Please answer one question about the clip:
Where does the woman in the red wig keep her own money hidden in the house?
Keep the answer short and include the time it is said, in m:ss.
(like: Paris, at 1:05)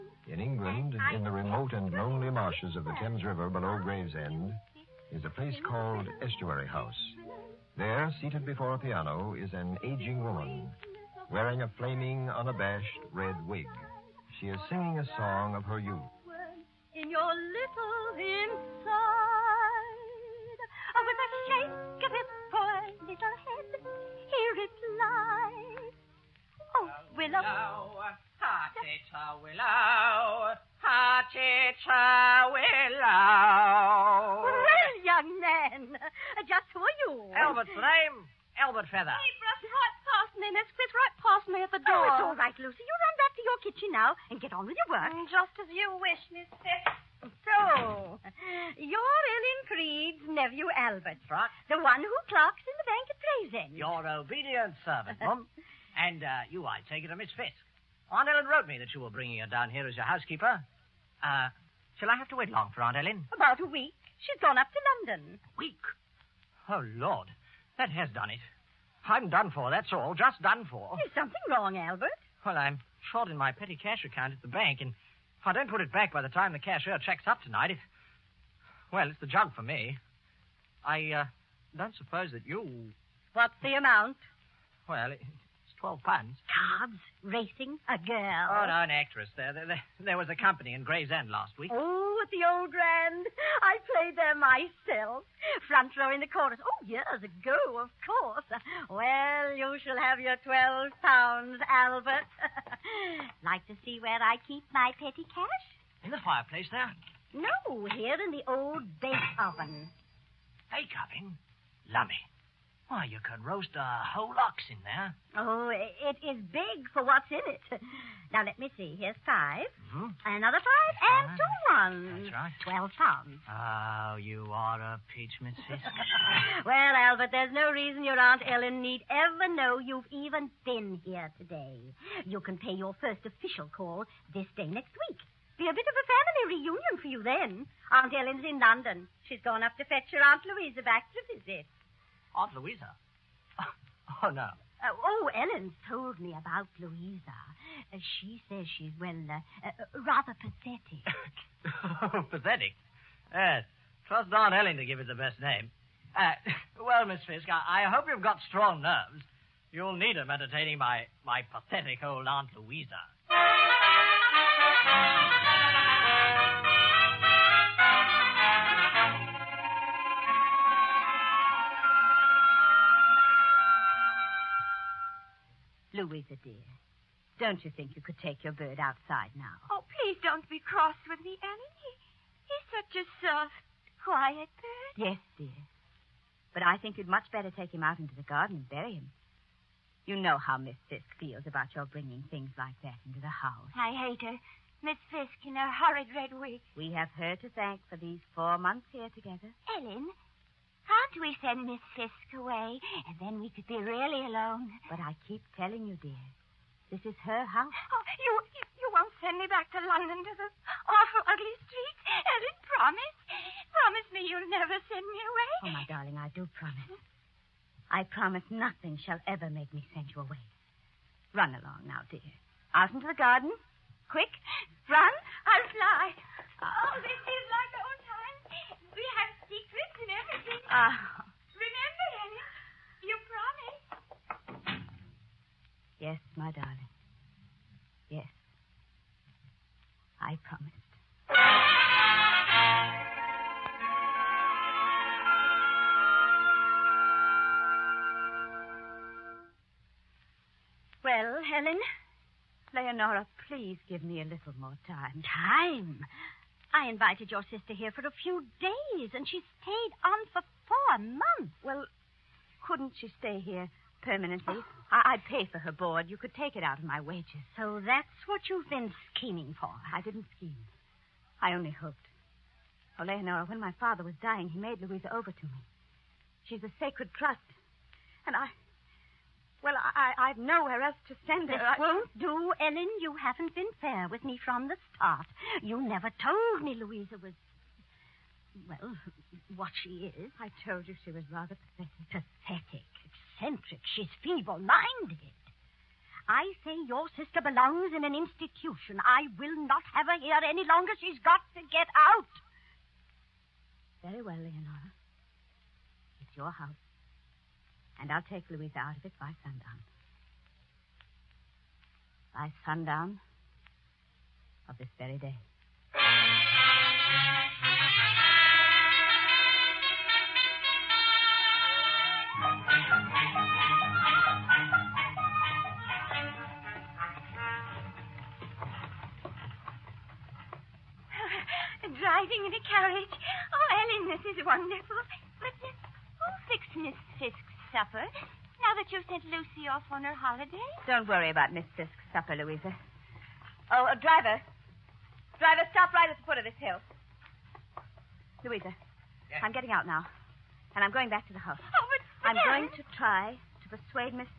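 the old bake oven, at 1:48.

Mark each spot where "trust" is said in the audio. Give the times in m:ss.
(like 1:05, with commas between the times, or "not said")
2:34, 4:37.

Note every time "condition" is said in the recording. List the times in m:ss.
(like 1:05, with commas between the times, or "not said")
not said.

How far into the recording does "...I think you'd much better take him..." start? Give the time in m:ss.
3:06.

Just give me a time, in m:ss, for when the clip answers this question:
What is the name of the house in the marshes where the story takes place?
0:06.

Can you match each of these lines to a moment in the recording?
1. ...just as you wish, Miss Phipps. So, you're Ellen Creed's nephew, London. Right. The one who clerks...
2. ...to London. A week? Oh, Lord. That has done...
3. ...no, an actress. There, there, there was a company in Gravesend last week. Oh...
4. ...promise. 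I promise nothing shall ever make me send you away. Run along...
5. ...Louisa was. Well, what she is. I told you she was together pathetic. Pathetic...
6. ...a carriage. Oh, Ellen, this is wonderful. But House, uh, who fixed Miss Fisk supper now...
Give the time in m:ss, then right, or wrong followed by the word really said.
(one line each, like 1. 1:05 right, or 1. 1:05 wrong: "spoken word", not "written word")
1. 0:45 wrong: "Albert", not "London"
2. 1:04 right
3. 1:28 right
4. 3:36 right
5. 4:46 wrong: "rather", not "together"
6. 5:32 wrong: "Miss", not "House".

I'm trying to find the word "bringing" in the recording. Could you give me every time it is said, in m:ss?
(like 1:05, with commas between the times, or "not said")
0:59, 3:11.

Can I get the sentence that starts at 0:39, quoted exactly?
He brushed right past me, and right past me at the door.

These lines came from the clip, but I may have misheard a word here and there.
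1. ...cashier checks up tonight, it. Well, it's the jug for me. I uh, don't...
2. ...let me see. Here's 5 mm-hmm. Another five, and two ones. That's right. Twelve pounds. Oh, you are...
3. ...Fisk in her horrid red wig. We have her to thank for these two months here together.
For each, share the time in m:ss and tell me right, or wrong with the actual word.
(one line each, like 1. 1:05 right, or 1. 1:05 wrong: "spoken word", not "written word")
1. 1:16 right
2. 1:58 right
3. 3:15 wrong: "four", not "two".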